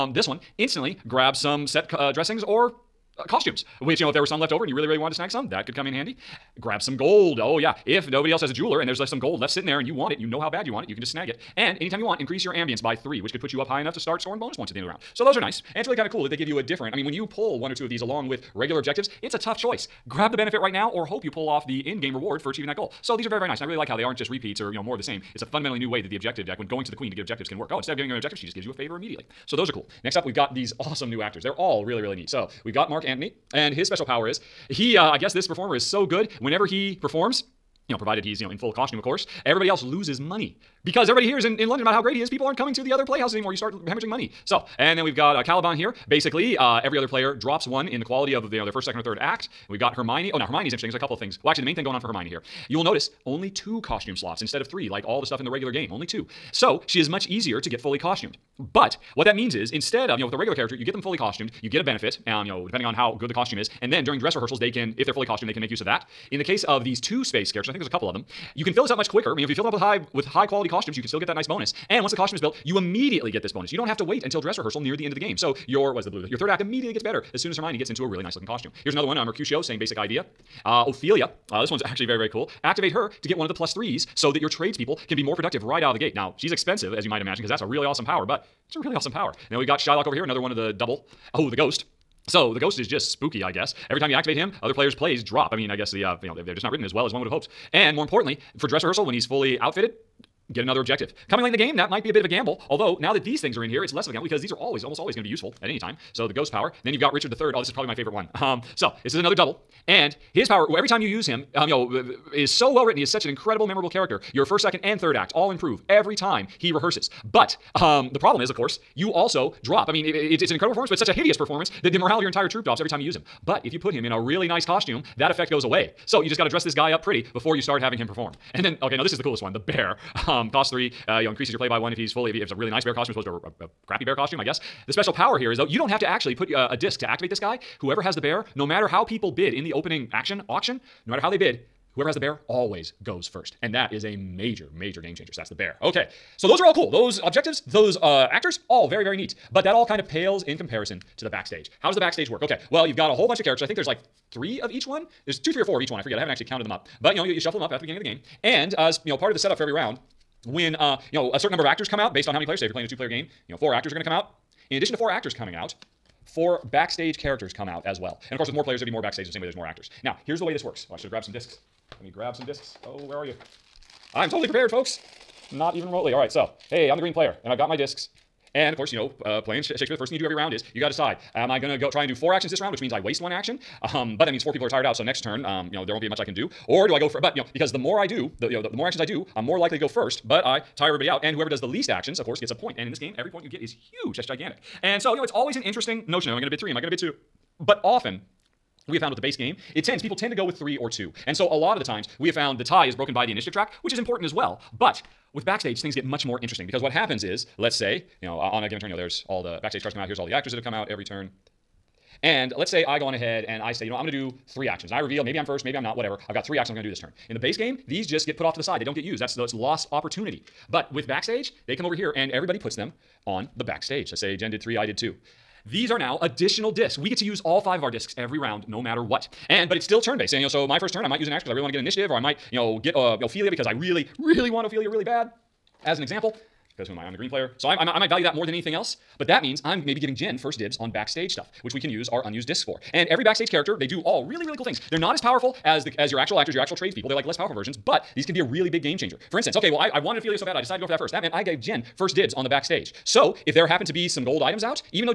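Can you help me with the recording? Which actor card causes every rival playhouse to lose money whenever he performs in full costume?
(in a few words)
Mark Antony.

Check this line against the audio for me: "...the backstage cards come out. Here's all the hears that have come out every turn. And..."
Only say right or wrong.
wrong.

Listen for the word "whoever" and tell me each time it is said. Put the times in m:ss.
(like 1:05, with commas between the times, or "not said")
2:17, 2:21, 3:11.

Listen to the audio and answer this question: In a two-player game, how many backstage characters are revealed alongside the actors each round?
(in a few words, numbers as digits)
4.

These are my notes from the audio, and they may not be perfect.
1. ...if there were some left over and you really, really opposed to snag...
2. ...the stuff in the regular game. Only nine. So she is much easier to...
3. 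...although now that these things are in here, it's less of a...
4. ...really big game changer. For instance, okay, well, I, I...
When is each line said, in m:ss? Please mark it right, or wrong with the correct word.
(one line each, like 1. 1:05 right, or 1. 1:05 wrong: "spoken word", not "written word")
1. 0:04 wrong: "wanted", not "opposed"
2. 0:55 wrong: "two", not "nine"
3. 1:42 right
4. 4:08 right.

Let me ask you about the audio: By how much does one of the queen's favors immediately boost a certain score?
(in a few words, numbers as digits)
3.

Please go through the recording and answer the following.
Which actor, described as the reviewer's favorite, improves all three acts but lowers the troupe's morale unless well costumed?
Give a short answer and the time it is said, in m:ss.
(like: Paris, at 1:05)
Richard III, at 1:47.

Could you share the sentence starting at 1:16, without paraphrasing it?
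Your third act immediately gets better as soon as Hermione gets into a really nice looking costume.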